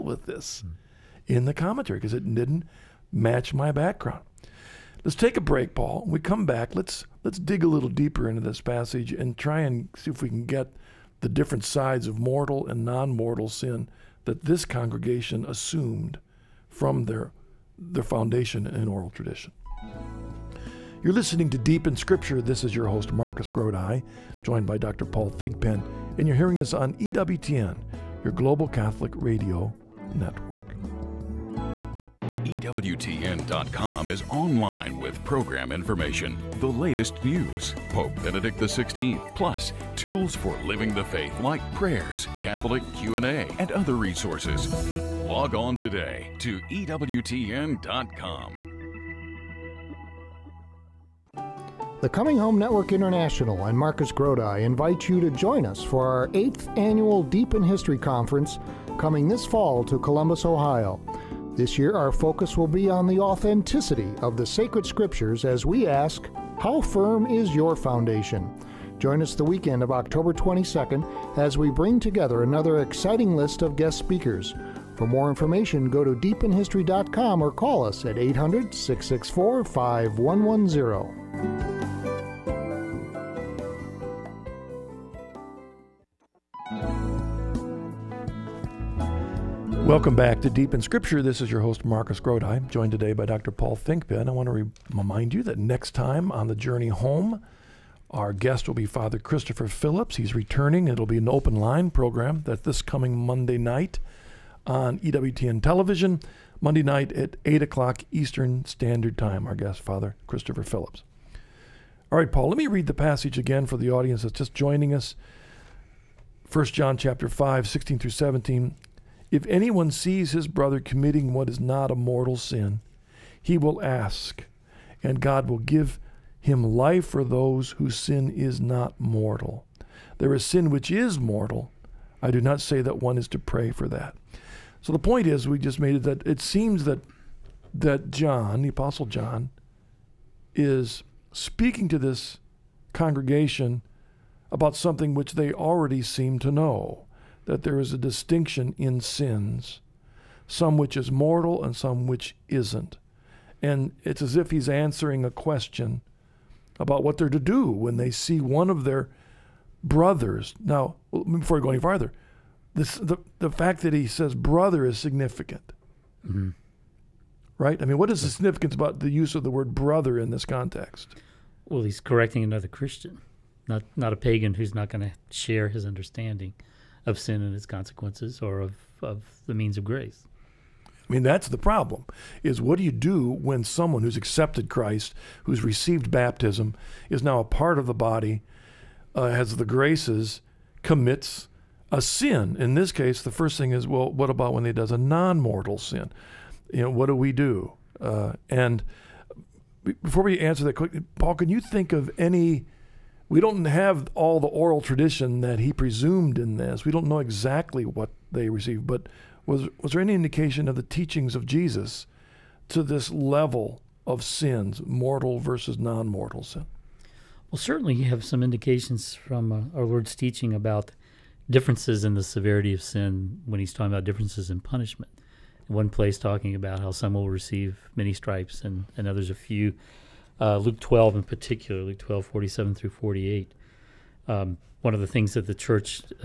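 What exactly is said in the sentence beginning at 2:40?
Now, before I go any farther, this, the, the fact that he says brother is significant.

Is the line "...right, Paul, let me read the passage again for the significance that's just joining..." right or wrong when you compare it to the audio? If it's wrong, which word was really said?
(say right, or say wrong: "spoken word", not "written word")
wrong: "audience", not "significance".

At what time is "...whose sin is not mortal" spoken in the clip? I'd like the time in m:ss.
2:07.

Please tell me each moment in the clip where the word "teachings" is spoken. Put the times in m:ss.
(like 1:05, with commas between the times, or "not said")
3:30, 3:40.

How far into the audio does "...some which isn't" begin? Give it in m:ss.
2:31.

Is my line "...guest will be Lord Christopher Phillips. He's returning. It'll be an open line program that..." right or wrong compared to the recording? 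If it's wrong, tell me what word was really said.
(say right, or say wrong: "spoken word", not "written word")
wrong: "Father", not "Lord".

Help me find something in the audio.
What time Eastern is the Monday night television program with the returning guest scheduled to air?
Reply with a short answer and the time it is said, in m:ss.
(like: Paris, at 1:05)
8 o'clock, at 1:47.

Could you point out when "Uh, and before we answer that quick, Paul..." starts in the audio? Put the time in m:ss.
3:18.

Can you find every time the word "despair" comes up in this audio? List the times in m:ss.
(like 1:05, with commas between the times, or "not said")
not said.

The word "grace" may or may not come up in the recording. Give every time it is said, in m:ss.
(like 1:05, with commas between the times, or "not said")
2:59, 3:09.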